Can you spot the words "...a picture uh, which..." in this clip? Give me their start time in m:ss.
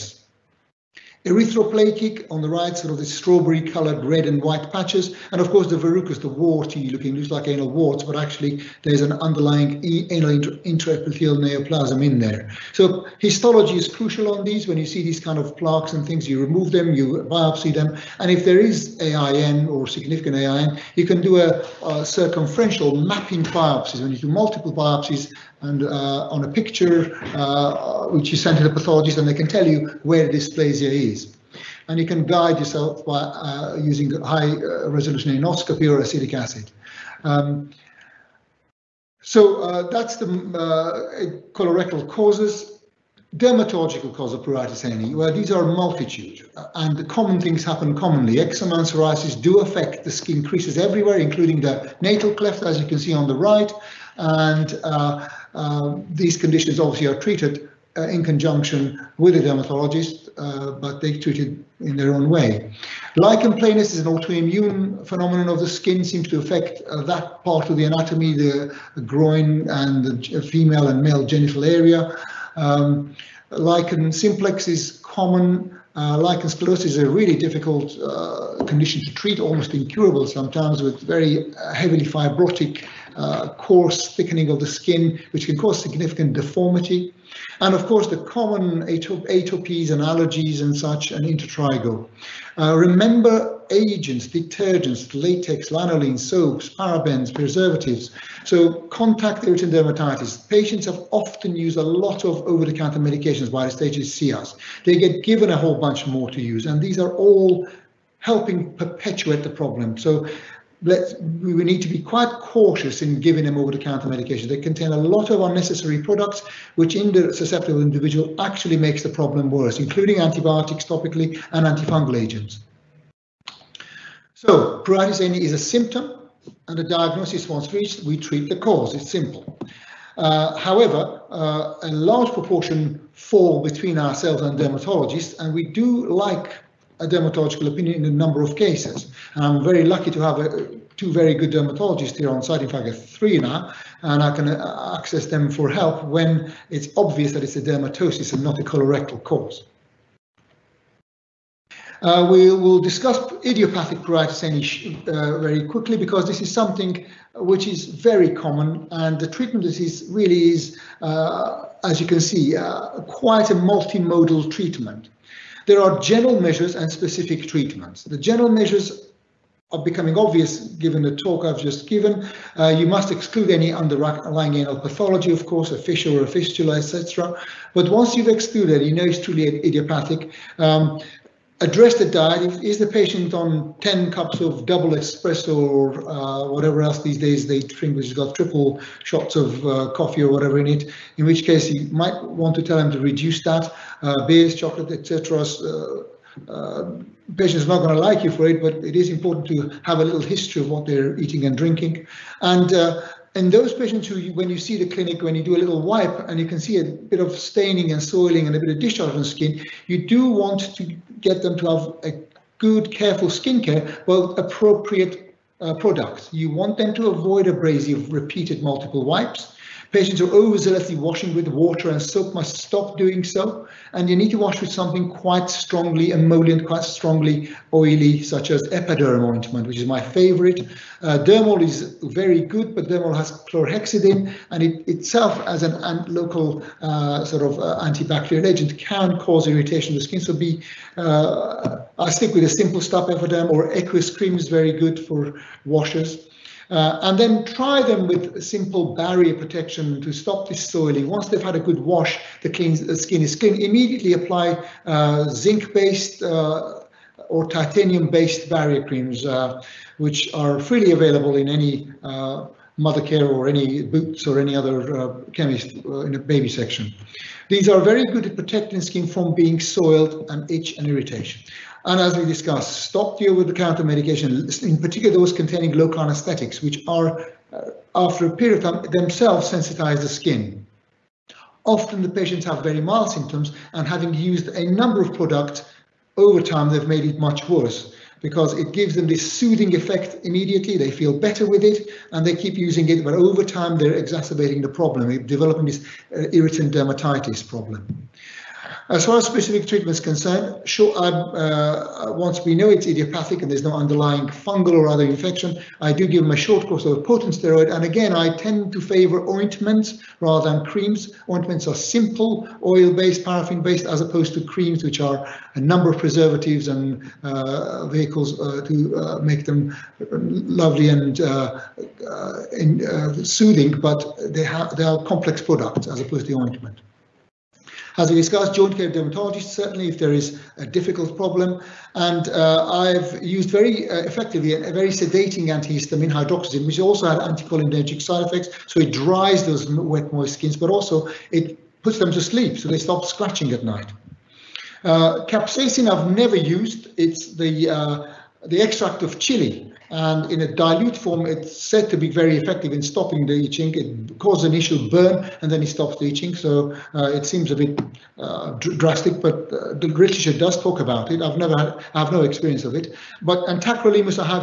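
0:26.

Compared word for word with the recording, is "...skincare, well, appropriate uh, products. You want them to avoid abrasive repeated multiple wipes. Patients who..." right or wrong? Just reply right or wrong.
right.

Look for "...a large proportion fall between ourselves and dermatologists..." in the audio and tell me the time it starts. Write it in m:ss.
2:11.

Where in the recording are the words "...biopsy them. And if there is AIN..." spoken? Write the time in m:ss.
0:17.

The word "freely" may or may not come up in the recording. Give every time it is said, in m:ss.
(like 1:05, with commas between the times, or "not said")
4:20.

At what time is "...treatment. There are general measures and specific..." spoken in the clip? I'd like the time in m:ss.
2:44.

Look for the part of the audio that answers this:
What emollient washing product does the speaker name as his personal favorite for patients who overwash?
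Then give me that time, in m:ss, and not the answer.
3:48.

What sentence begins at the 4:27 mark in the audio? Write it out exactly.
These are very good at protecting skin from being soiled and itch and irritation.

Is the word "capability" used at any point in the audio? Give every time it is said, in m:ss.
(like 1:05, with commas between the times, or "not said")
not said.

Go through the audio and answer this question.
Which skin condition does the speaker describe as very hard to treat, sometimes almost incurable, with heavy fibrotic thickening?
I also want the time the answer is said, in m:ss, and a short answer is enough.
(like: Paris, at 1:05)
Lichen sclerosis, at 1:16.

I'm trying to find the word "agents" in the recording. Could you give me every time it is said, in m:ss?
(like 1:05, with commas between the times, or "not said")
1:33, 2:02, 3:58.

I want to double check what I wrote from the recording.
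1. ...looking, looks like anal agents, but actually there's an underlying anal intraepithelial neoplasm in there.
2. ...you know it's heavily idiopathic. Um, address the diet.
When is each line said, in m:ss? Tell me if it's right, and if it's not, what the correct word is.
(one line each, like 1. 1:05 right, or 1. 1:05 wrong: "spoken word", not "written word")
1. 0:06 wrong: "warts", not "agents"
2. 2:58 wrong: "truly", not "heavily".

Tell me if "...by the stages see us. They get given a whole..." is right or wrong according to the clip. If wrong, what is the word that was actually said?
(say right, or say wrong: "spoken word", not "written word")
right.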